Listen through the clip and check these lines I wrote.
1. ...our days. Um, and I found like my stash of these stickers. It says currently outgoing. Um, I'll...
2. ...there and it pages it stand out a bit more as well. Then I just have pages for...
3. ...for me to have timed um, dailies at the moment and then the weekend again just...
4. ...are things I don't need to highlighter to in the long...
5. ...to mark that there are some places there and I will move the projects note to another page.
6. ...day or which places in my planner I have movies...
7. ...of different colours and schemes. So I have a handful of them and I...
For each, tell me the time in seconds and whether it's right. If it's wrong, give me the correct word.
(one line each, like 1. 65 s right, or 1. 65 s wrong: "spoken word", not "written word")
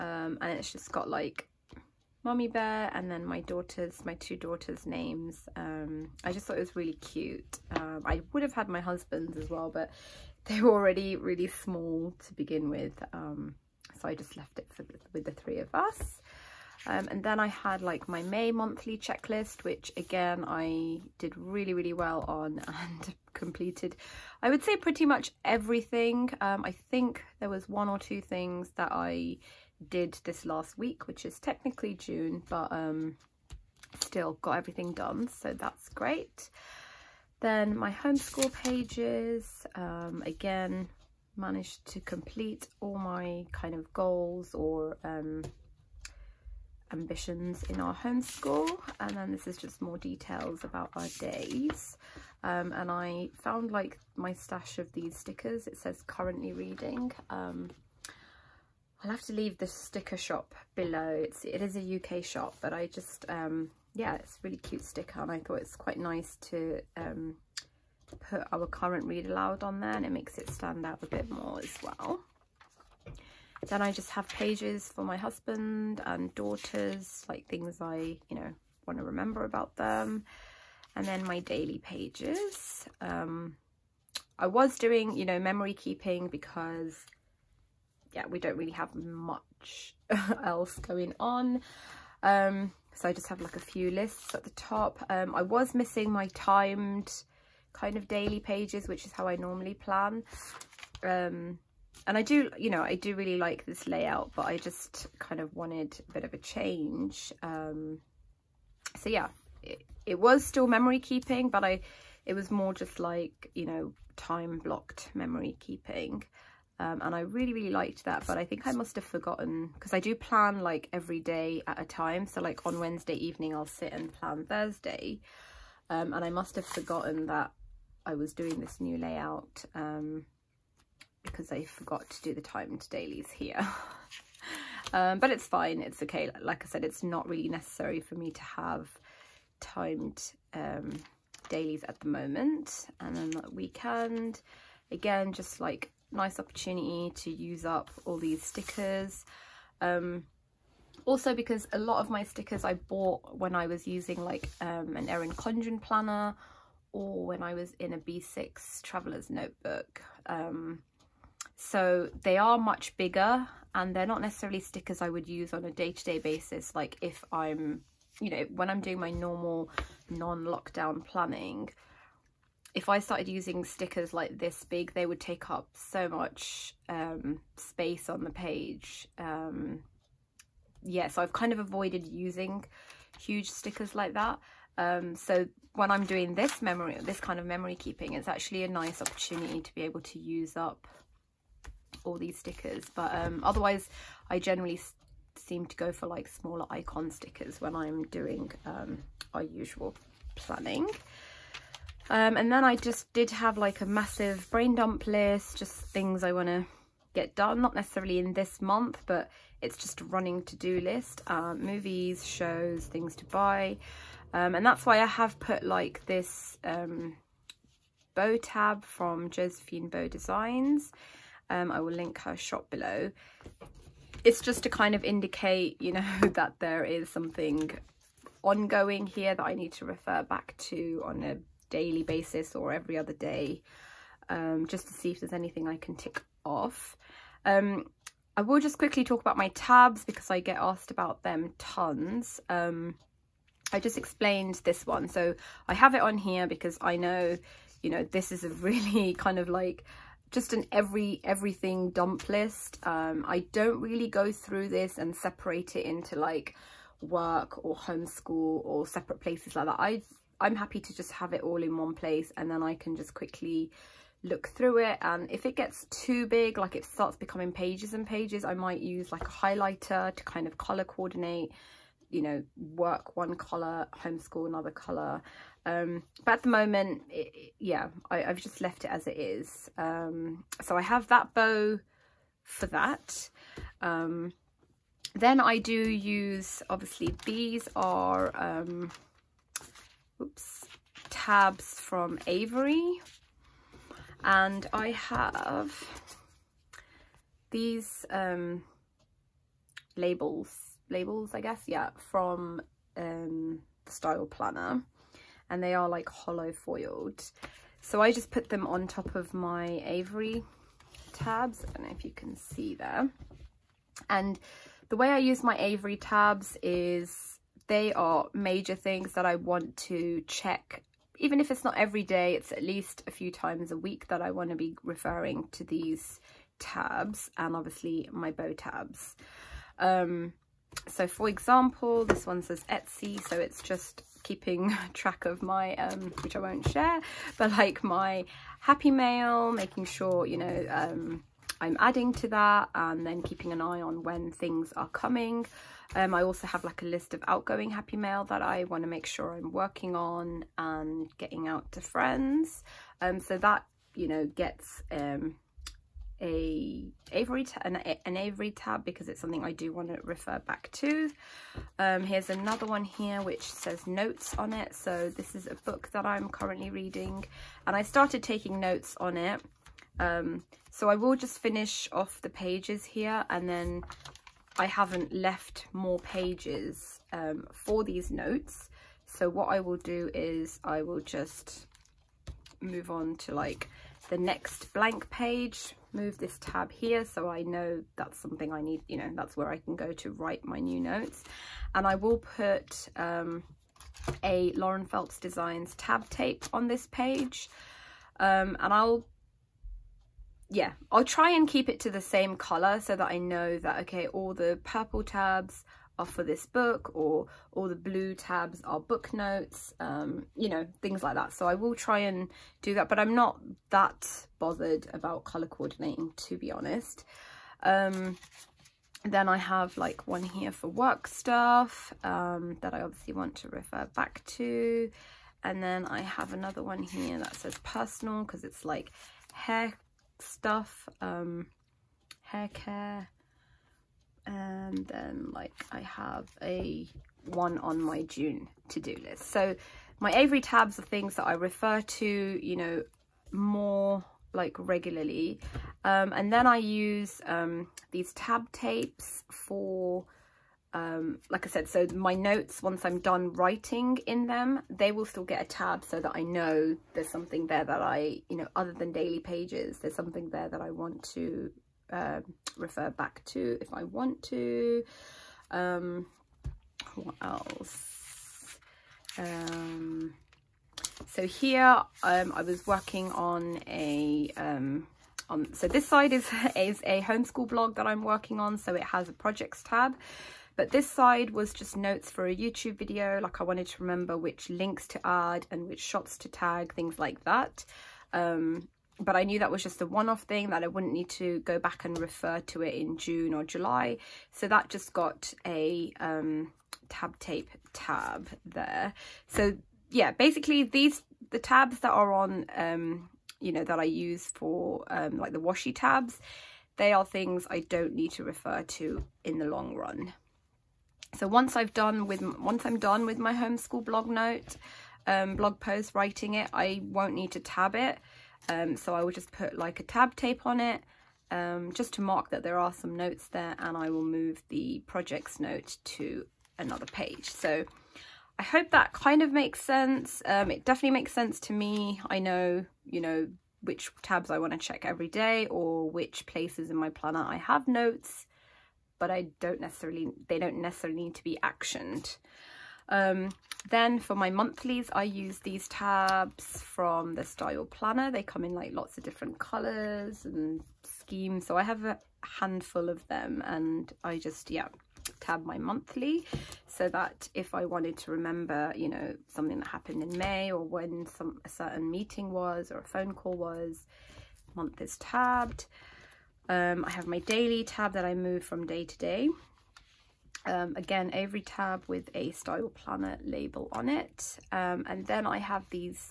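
1. 50 s wrong: "reading", not "outgoing"
2. 69 s wrong: "makes", not "pages"
3. 138 s right
4. 506 s wrong: "refer", not "highlighter"
5. 521 s wrong: "notes", not "places"
6. 535 s wrong: "notes", not "movies"
7. 548 s right.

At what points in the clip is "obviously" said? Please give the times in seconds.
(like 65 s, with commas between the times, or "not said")
286 s, 327 s, 422 s.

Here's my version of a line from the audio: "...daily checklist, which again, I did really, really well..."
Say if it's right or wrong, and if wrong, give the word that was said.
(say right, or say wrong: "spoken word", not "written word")
wrong: "monthly", not "daily".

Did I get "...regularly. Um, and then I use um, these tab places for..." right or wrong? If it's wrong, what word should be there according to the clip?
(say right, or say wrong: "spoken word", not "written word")
wrong: "tapes", not "places".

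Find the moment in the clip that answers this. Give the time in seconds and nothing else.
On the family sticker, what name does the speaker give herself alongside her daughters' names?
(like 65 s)
2 s.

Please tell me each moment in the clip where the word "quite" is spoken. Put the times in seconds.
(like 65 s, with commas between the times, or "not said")
65 s.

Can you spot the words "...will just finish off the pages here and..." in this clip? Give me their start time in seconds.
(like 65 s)
370 s.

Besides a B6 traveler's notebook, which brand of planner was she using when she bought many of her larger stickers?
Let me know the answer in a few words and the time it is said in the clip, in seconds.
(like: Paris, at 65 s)
Erin Condren, at 155 s.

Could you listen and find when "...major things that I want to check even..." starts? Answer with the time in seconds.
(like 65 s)
318 s.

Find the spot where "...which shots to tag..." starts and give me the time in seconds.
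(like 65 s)
485 s.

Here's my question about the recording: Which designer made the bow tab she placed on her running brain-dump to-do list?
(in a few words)
Josephine Bow Designs.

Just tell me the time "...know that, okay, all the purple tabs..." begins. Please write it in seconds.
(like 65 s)
403 s.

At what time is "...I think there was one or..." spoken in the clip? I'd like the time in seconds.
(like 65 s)
26 s.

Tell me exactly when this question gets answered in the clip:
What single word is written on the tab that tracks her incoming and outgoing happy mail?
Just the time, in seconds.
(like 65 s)
332 s.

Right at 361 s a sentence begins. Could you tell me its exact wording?
Um, here's another one here which says notes on it.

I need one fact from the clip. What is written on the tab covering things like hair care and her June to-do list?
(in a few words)
Personal.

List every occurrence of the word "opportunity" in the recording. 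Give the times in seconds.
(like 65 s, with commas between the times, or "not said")
146 s, 189 s.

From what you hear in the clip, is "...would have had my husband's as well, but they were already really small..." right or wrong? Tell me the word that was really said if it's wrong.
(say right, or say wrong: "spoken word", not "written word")
right.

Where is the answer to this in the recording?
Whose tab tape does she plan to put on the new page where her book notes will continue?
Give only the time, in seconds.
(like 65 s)
394 s.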